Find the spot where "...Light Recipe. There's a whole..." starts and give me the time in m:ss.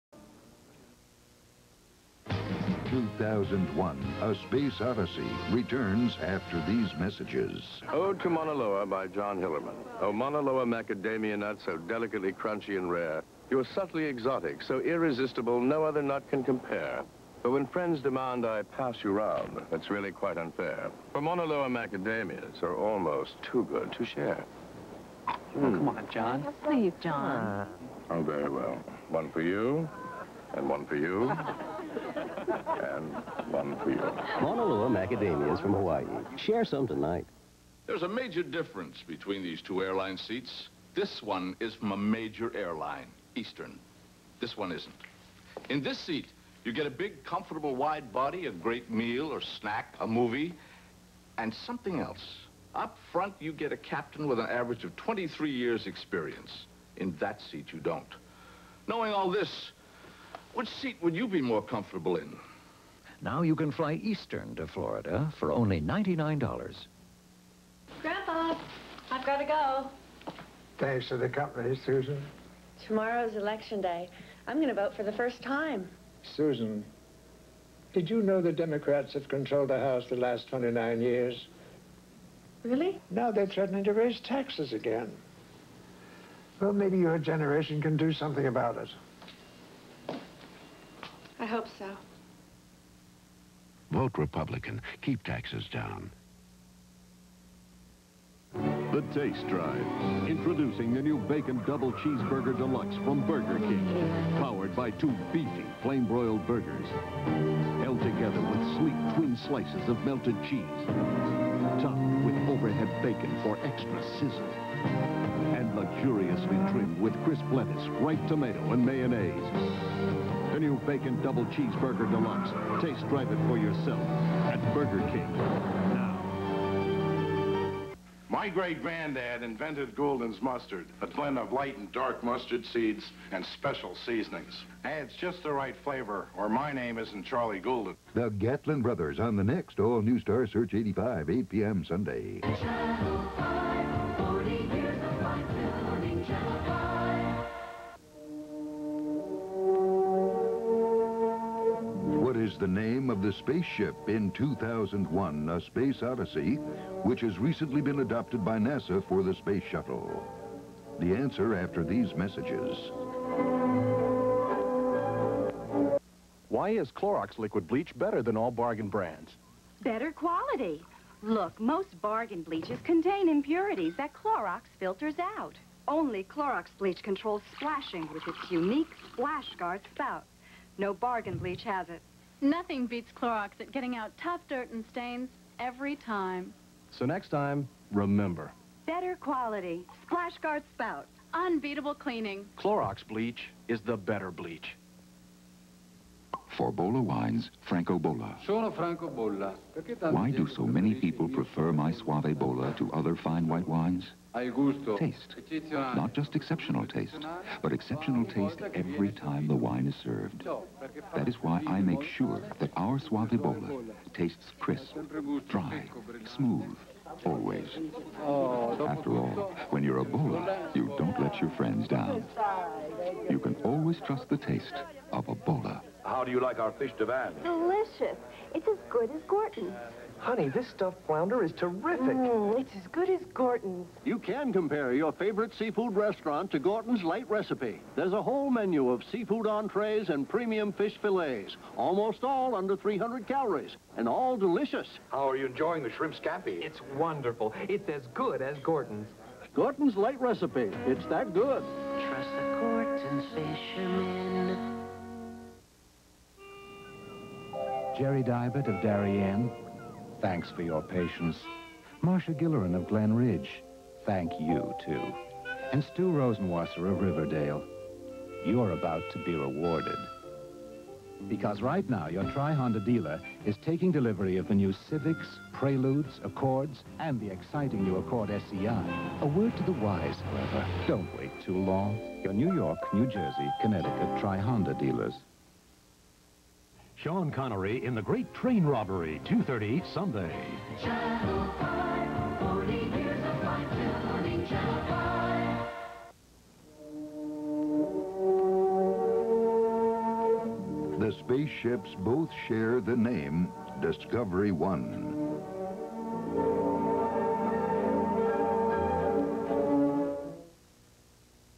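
3:57.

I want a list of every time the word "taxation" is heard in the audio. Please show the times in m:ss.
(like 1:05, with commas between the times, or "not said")
not said.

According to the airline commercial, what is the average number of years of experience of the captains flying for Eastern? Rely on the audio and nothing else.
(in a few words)
23 years.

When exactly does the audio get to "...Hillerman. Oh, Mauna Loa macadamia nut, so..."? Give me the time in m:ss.
0:09.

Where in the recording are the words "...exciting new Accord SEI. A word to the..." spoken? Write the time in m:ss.
4:37.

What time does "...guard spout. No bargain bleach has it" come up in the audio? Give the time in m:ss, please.
2:59.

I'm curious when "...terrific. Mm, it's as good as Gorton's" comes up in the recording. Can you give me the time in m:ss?
3:51.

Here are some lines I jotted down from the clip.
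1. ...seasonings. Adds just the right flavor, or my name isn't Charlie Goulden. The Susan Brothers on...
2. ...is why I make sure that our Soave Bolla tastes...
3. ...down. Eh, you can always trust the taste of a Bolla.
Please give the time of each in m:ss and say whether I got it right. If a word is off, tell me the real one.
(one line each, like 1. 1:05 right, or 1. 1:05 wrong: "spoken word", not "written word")
1. 2:13 wrong: "Gatlin", not "Susan"
2. 3:31 right
3. 3:41 right.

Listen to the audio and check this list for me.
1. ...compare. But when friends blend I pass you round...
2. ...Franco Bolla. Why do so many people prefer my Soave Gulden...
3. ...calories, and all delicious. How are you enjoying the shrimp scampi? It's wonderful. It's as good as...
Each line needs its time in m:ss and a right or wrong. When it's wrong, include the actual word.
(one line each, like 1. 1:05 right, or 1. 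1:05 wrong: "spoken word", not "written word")
1. 0:16 wrong: "demand", not "blend"
2. 3:18 wrong: "Bolla", not "Gulden"
3. 4:03 right.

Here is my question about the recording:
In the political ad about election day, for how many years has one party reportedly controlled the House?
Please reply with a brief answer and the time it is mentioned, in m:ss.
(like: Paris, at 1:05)
29 years, at 1:20.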